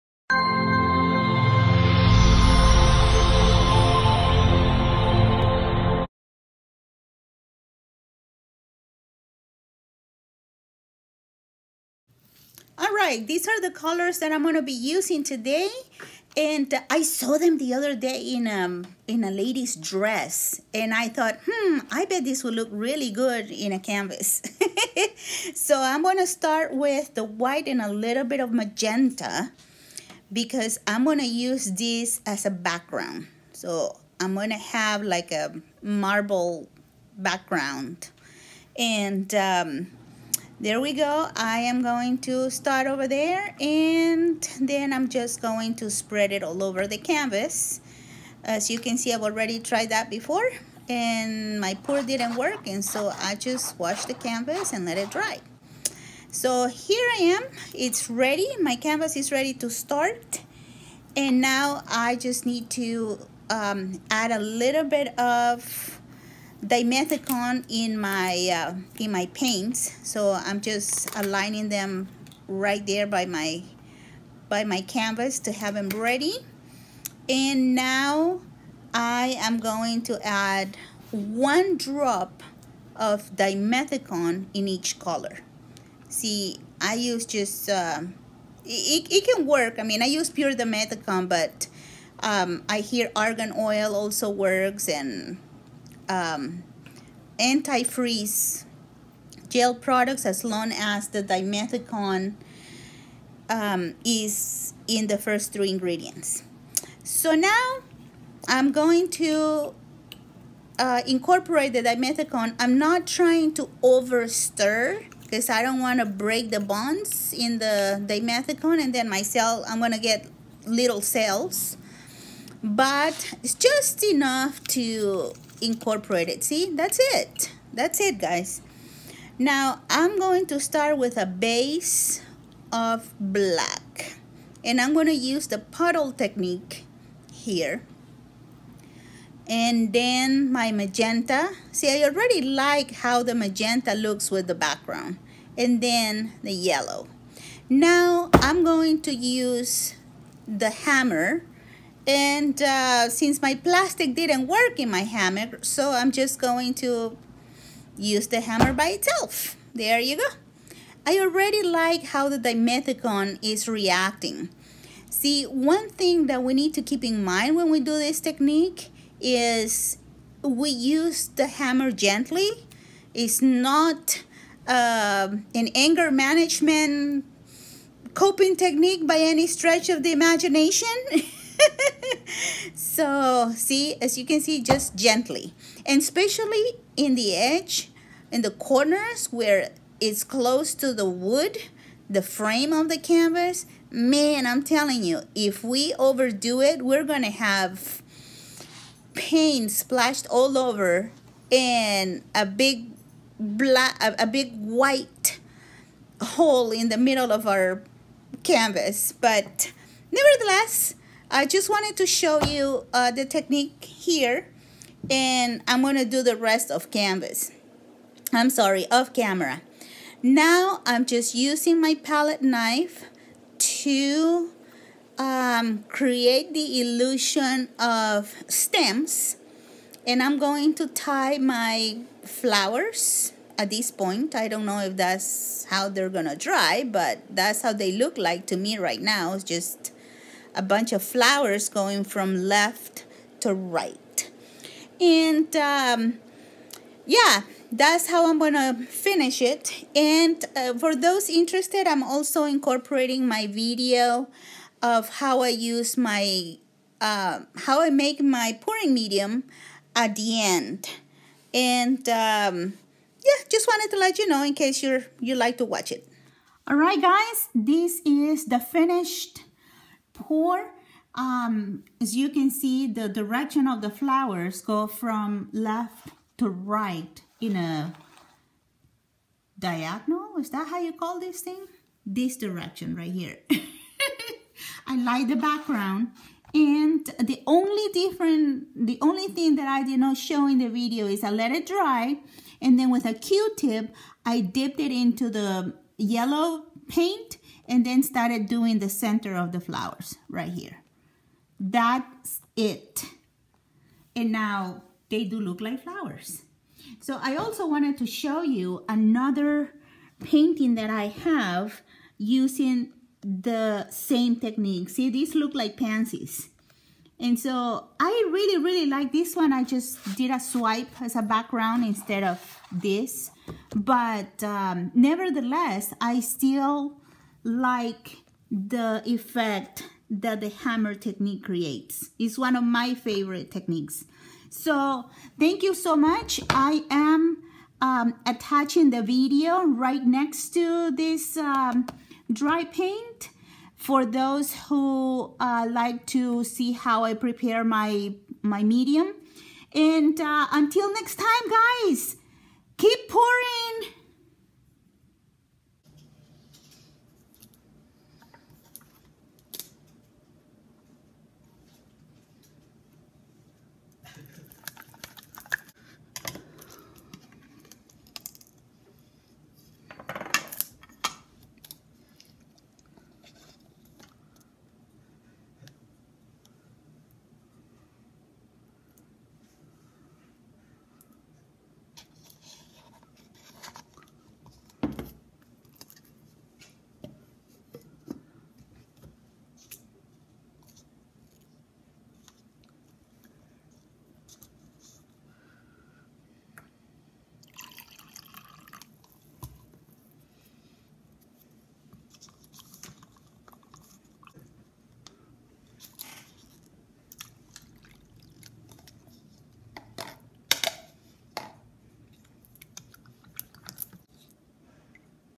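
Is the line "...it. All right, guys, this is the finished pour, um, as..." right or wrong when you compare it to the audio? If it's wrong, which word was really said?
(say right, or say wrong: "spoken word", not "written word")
right.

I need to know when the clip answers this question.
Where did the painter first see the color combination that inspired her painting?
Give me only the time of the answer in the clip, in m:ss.
0:19.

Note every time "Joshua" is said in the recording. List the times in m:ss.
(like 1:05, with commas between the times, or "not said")
not said.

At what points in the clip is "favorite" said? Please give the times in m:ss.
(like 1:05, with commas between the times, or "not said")
5:32.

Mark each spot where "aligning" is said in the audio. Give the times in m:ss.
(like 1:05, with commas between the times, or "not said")
1:11.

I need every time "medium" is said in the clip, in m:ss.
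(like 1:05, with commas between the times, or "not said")
4:18, 5:48.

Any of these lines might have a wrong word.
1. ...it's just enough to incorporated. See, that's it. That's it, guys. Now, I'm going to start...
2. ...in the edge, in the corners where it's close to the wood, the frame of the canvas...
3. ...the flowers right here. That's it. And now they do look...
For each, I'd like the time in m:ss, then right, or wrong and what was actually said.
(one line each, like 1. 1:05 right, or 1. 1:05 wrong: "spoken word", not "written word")
1. 2:03 right
2. 3:06 right
3. 4:59 right.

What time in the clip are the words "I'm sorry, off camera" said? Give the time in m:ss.
3:38.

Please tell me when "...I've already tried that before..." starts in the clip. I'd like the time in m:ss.
0:49.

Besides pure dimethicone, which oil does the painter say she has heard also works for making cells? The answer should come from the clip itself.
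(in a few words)
Argan oil.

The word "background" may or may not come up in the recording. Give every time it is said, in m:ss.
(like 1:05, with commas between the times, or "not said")
0:32, 0:37, 2:24, 4:45, 5:21.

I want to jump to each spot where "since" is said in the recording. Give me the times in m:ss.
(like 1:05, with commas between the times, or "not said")
2:33.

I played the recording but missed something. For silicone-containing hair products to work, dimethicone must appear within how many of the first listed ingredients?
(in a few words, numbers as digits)
3.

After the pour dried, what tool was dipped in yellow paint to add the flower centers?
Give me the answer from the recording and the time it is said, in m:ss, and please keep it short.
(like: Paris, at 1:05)
Q-tip, at 4:53.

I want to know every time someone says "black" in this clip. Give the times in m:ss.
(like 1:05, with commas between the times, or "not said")
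2:13, 3:23.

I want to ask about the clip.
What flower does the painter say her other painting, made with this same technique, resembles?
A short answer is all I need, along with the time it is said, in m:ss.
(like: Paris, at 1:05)
Pansies, at 5:15.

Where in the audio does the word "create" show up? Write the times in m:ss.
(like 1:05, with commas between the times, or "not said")
3:45, 5:31.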